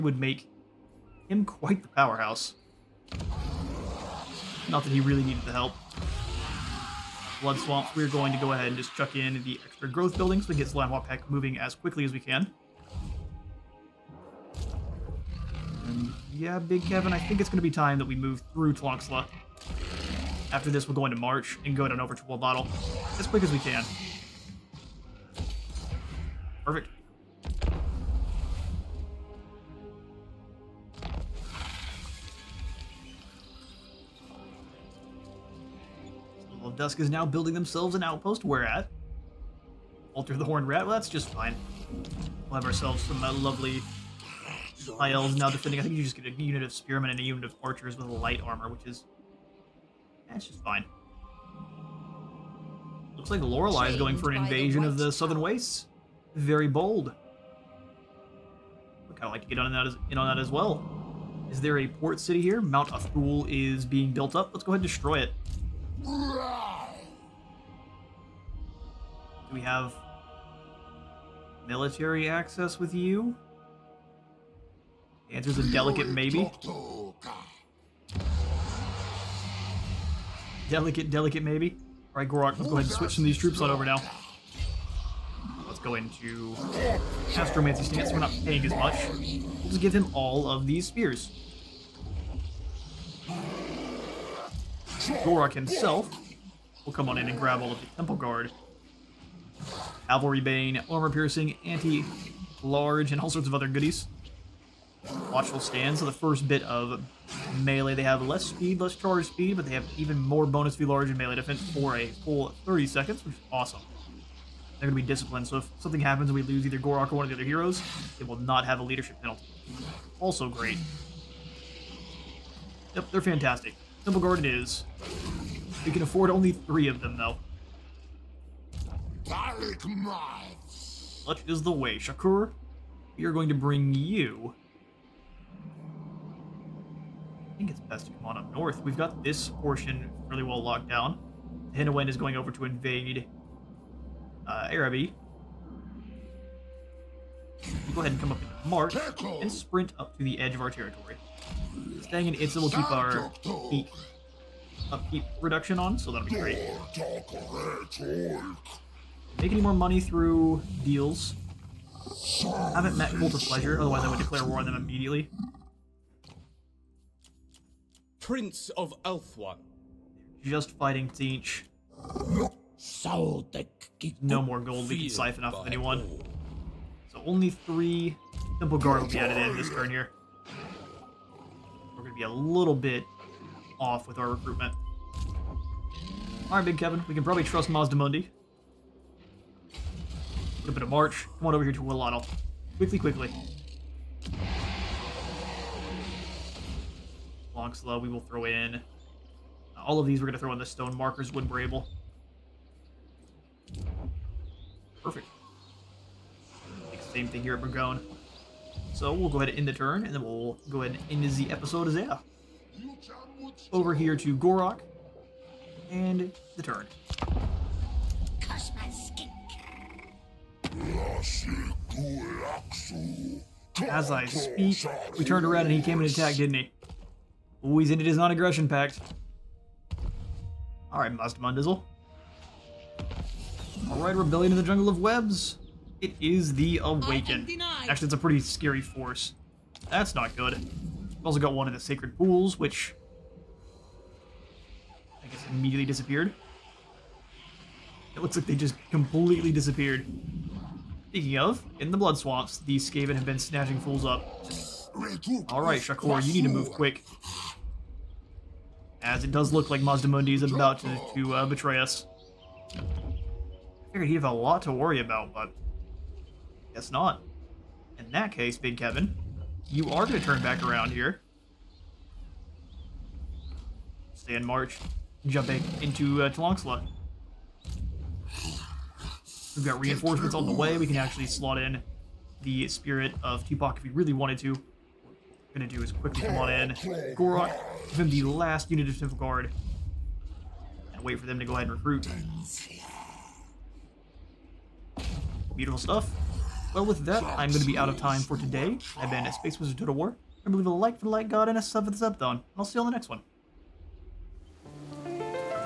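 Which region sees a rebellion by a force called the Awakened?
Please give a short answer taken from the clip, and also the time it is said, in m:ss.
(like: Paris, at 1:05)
Jungle of Webs, at 3:54.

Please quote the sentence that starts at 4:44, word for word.
What we're going to do is quickly come on in.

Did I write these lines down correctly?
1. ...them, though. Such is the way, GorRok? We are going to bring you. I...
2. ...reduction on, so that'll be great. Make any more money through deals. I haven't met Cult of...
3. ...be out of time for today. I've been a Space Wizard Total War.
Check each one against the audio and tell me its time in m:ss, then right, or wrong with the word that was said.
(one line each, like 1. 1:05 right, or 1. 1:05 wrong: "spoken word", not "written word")
1. 2:07 wrong: "Shakur", not "GorRok"
2. 2:35 right
3. 4:57 right.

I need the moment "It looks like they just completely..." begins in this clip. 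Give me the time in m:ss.
4:08.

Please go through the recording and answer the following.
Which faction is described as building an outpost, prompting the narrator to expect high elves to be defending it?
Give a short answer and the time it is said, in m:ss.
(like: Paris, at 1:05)
Dusk, at 0:36.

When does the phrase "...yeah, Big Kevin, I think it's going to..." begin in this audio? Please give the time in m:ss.
0:16.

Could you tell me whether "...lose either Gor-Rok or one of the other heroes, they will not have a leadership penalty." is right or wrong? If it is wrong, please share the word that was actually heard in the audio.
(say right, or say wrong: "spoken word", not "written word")
right.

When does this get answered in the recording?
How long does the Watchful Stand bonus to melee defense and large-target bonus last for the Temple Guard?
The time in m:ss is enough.
1:52.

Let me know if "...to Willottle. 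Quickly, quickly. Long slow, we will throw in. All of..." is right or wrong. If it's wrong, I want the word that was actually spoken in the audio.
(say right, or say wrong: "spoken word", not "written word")
right.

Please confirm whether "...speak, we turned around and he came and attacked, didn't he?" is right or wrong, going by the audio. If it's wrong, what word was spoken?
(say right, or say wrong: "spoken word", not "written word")
right.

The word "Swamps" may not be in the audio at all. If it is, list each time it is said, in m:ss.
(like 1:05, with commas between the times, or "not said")
0:07, 4:12.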